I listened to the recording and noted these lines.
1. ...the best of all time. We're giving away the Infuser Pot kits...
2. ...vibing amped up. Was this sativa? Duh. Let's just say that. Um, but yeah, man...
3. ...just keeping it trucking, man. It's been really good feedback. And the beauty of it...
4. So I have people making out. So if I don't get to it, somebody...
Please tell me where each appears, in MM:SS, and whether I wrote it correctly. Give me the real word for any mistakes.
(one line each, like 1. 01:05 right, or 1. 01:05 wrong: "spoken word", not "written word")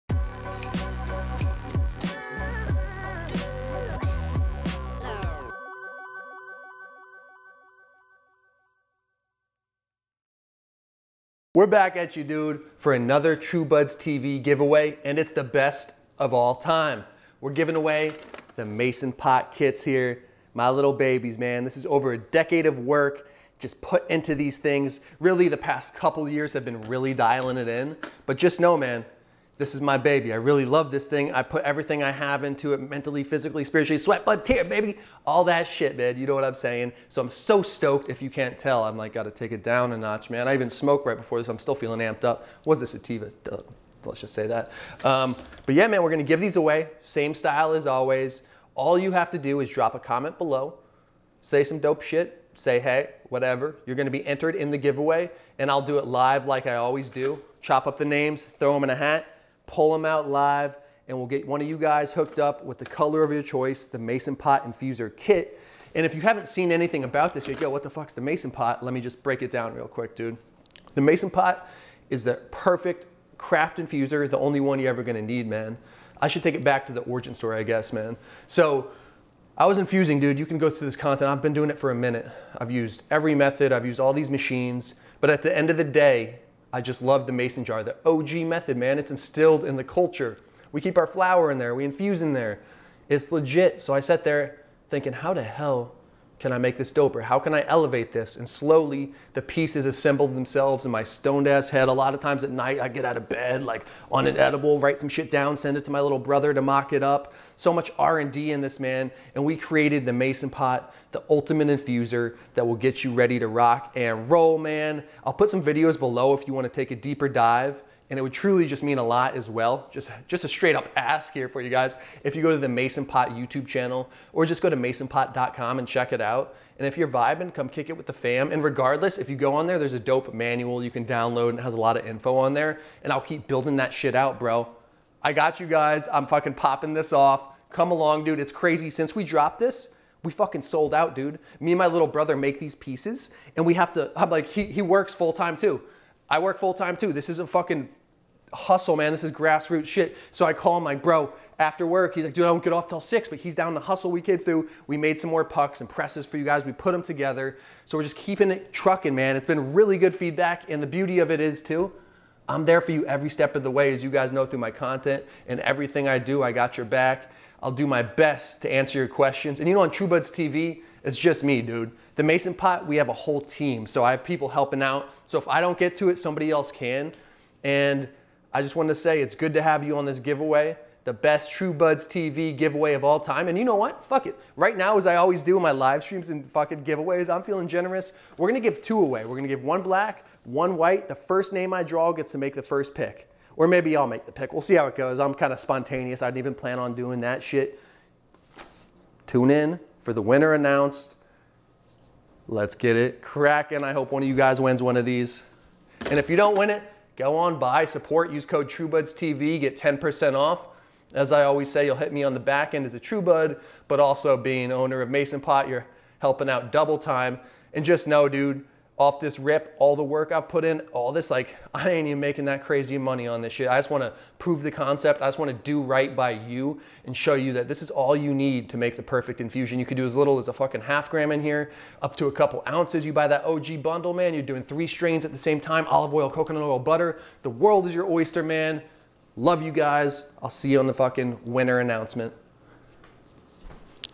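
1. 00:15 wrong: "Mason", not "Infuser"
2. 00:41 wrong: "feeling", not "vibing"
3. 02:38 right
4. 02:53 wrong: "helping", not "making".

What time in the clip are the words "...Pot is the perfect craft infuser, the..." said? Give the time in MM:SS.
01:11.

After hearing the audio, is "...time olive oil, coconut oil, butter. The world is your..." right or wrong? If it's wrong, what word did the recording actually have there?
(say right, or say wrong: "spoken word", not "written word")
right.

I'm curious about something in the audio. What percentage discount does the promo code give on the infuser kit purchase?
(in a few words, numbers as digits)
10%.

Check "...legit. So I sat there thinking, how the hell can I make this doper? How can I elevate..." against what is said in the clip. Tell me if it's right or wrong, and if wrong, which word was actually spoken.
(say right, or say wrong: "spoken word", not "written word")
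right.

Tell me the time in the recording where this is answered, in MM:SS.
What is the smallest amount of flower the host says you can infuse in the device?
03:50.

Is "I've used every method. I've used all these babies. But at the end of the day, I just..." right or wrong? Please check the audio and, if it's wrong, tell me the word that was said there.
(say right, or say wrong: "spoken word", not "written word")
wrong: "machines", not "babies".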